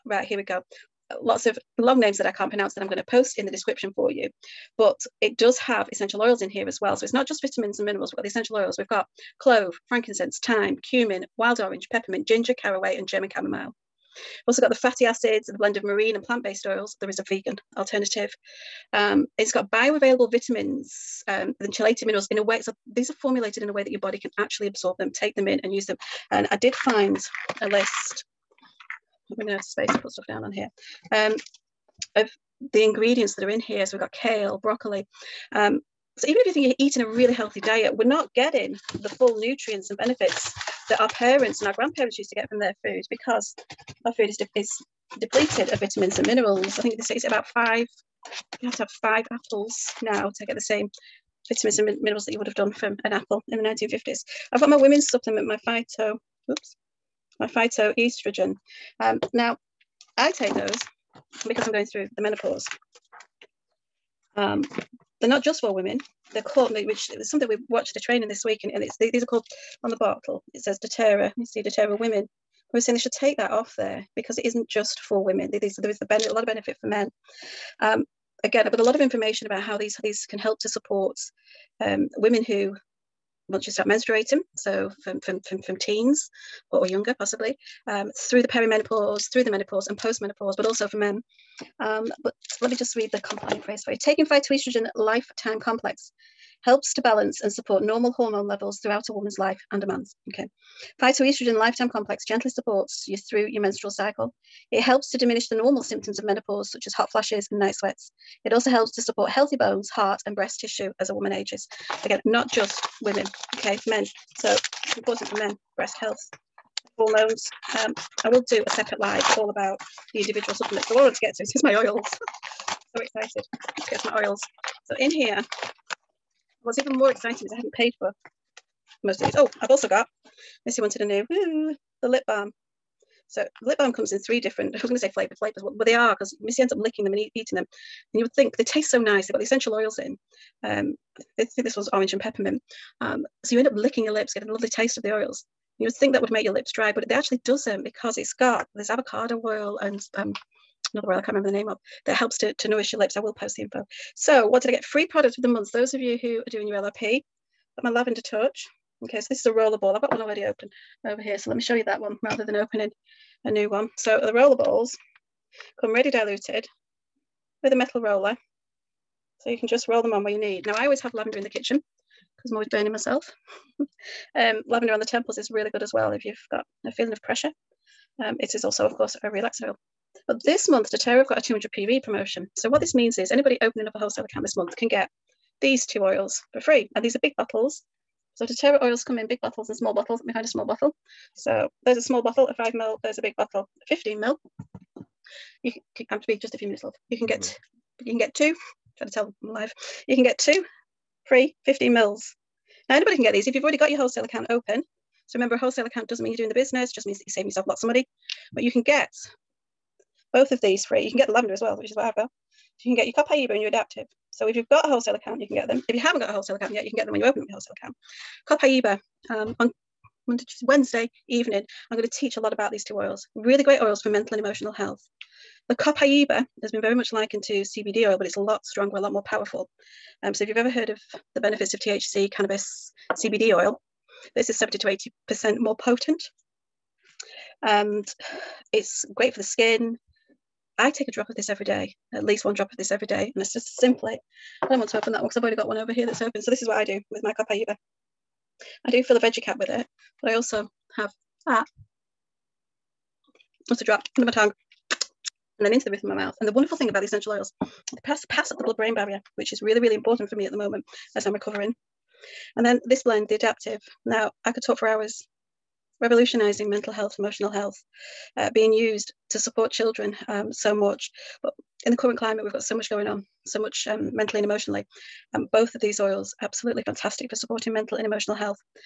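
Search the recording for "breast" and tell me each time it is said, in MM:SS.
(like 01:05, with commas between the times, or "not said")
01:50, 01:55.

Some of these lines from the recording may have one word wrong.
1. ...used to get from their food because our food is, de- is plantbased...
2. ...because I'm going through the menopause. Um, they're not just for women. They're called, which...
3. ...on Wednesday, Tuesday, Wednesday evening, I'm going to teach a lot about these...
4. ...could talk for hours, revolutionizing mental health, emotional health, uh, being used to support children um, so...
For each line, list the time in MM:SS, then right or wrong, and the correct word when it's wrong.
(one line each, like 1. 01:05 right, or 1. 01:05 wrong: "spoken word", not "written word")
1. 00:42 wrong: "depleted", not "plantbased"
2. 01:01 right
3. 03:39 wrong: "Monday", not "Wednesday"
4. 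04:24 right.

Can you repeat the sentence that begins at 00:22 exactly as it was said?
So these are formulated in a way that your body can actually absorb them, take them in, and use them.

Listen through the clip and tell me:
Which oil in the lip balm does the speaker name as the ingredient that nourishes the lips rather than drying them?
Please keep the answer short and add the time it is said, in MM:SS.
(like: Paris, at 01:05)
avocado oil, at 02:28.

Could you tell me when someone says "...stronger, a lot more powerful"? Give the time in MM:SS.
03:48.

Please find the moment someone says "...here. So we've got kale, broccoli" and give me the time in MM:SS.
00:33.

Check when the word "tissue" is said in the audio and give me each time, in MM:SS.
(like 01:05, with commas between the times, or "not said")
01:50.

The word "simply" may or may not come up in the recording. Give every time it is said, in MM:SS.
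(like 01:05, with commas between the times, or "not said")
04:03.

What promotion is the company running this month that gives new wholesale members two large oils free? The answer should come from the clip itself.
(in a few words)
200 PV.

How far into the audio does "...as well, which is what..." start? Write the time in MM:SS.
03:31.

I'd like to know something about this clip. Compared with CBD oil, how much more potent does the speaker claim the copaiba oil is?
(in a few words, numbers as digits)
70 to 80%.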